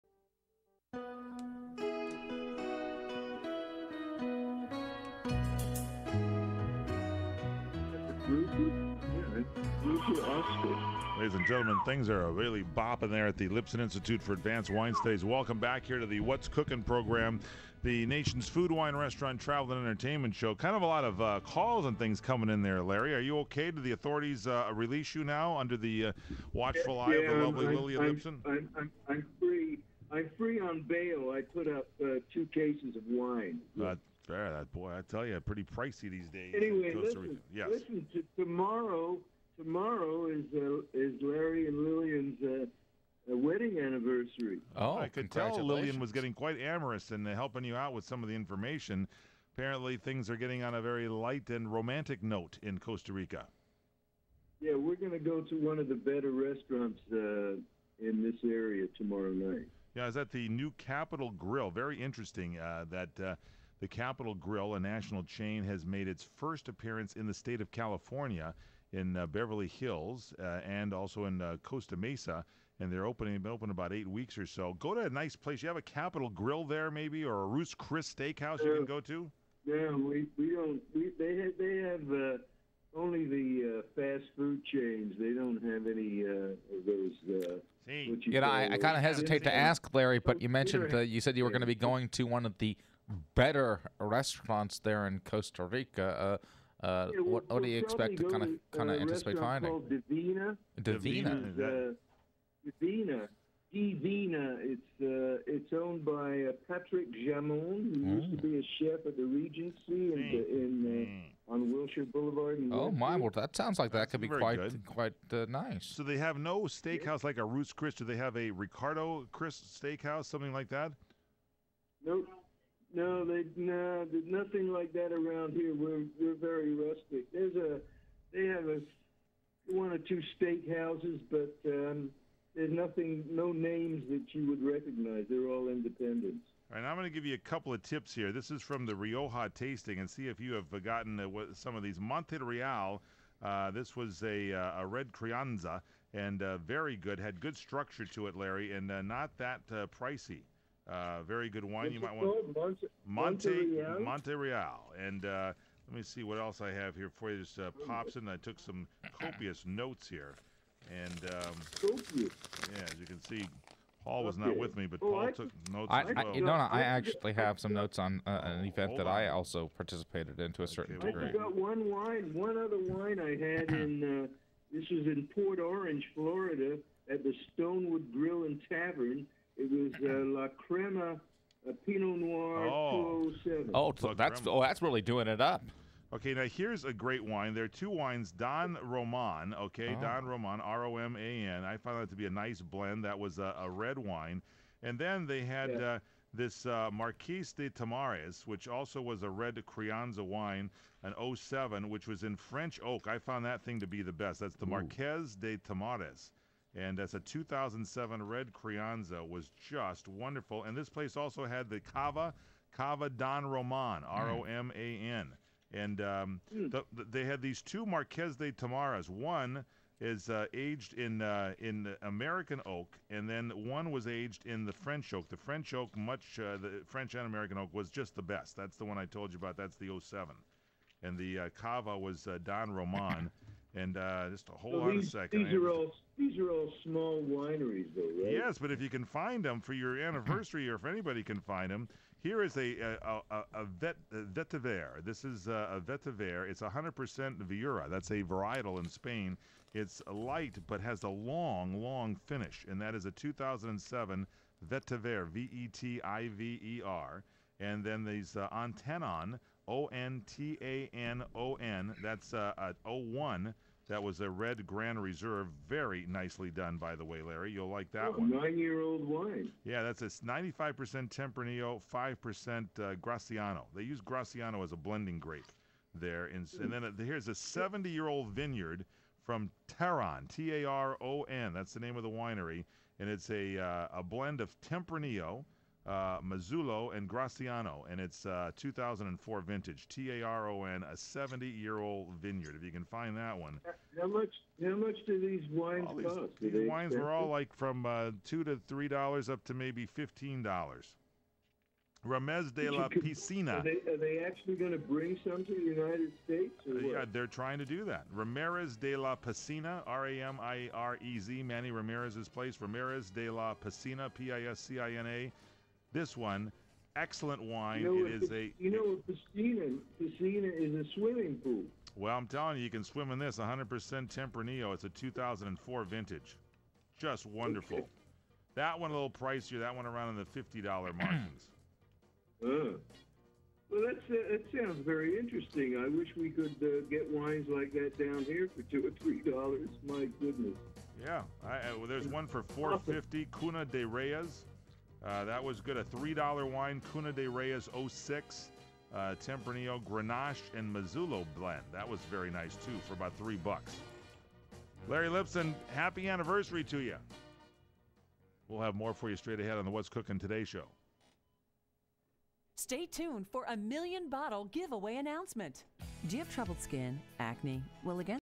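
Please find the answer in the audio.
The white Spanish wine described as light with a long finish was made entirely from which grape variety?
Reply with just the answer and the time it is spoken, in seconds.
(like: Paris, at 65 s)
Viura, at 247 s.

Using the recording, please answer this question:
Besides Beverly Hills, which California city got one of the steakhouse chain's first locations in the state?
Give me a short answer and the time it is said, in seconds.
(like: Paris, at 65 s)
Costa Mesa, at 71 s.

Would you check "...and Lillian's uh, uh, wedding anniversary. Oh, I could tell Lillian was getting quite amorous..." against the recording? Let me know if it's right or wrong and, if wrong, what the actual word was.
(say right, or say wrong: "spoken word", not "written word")
right.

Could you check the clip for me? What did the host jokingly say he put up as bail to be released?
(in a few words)
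2 cases of wine.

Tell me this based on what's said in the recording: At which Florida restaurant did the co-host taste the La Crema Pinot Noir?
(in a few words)
Stonewood Grill and Tavern.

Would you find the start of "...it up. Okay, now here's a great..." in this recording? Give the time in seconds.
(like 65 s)
185 s.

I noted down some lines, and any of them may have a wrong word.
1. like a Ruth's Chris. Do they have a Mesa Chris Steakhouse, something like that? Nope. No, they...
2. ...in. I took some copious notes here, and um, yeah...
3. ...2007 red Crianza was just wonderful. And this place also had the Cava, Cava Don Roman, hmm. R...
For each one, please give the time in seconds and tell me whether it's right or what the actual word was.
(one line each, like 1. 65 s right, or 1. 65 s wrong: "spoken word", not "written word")
1. 117 s wrong: "Ricardo", not "Mesa"
2. 158 s right
3. 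207 s right.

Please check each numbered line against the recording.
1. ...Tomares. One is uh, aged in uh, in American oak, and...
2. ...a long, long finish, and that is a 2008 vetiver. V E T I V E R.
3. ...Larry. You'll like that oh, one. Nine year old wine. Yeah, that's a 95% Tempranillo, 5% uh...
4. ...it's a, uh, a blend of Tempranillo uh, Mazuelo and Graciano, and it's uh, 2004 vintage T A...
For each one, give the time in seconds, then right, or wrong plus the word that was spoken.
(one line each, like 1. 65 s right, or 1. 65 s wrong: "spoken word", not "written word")
1. 218 s right
2. 251 s wrong: "2007", not "2008"
3. 267 s right
4. 283 s right.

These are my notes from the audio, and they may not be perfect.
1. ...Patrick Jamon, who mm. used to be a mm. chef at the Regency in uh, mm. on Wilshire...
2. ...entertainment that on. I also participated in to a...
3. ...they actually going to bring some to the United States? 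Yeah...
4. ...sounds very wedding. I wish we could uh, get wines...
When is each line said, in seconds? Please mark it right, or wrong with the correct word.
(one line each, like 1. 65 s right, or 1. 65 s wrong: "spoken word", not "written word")
1. 106 s right
2. 168 s wrong: "event", not "entertainment"
3. 303 s right
4. 334 s wrong: "interesting", not "wedding".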